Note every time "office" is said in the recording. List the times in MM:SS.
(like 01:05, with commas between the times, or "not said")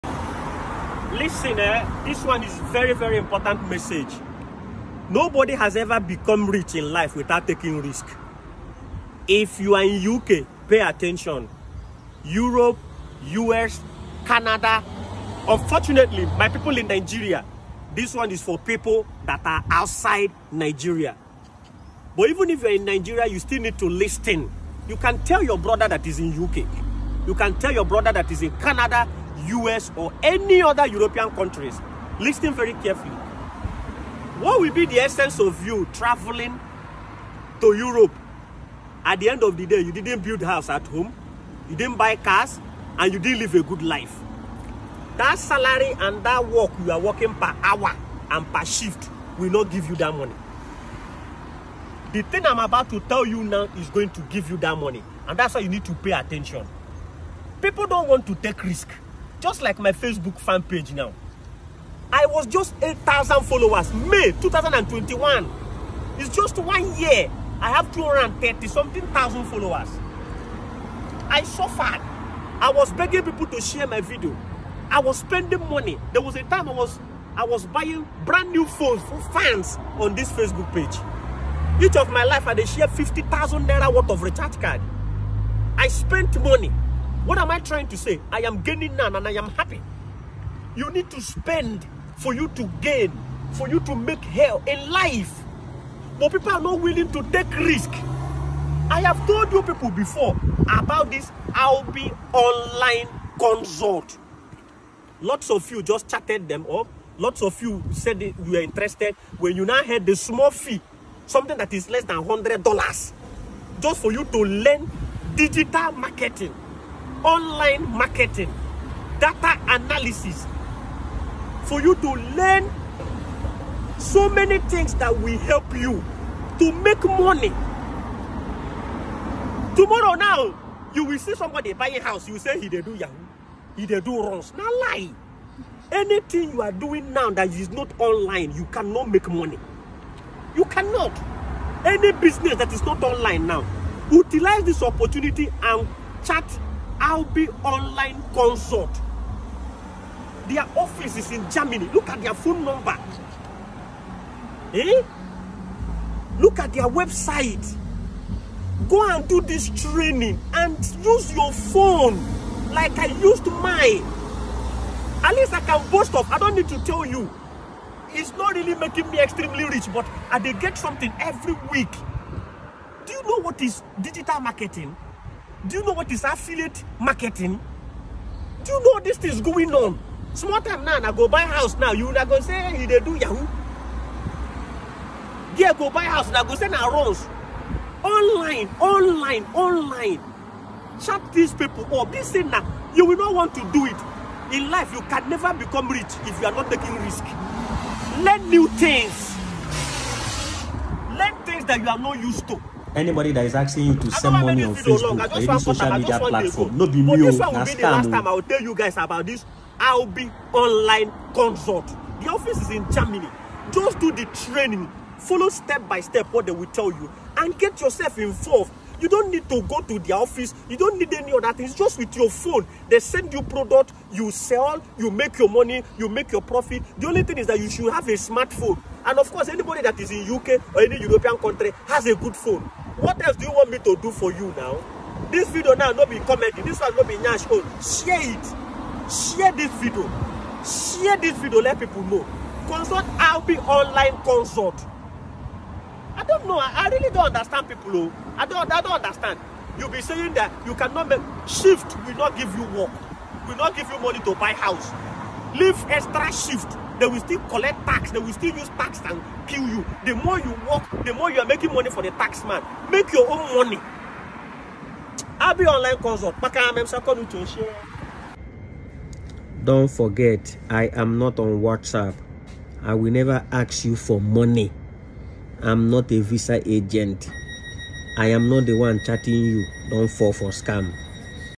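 02:30, 03:32, 03:40.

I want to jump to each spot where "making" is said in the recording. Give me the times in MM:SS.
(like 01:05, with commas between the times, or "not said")
02:48, 04:21.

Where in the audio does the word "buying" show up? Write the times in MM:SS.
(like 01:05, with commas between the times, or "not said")
01:17, 02:11.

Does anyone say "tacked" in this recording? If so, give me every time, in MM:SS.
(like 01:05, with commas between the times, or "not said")
not said.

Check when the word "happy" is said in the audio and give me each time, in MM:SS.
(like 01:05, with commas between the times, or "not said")
01:29.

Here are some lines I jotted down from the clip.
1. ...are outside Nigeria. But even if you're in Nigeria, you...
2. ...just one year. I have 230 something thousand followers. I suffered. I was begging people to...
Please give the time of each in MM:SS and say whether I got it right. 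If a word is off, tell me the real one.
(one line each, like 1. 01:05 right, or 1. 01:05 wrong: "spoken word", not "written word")
1. 00:19 right
2. 01:06 right.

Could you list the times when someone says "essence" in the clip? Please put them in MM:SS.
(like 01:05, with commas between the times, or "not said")
00:34.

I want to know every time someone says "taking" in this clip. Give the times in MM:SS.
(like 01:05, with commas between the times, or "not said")
00:07, 03:16.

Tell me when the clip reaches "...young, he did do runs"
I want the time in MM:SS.
02:12.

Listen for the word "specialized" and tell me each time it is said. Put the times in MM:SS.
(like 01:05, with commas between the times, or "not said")
not said.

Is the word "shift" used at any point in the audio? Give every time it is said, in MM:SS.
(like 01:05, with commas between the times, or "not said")
00:48, 04:11, 04:16.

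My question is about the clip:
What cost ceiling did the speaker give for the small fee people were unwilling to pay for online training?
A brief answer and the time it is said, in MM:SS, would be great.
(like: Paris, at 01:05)
less than $100, at 01:51.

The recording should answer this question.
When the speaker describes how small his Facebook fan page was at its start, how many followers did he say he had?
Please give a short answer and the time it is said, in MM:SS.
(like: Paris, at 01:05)
8,000, at 01:02.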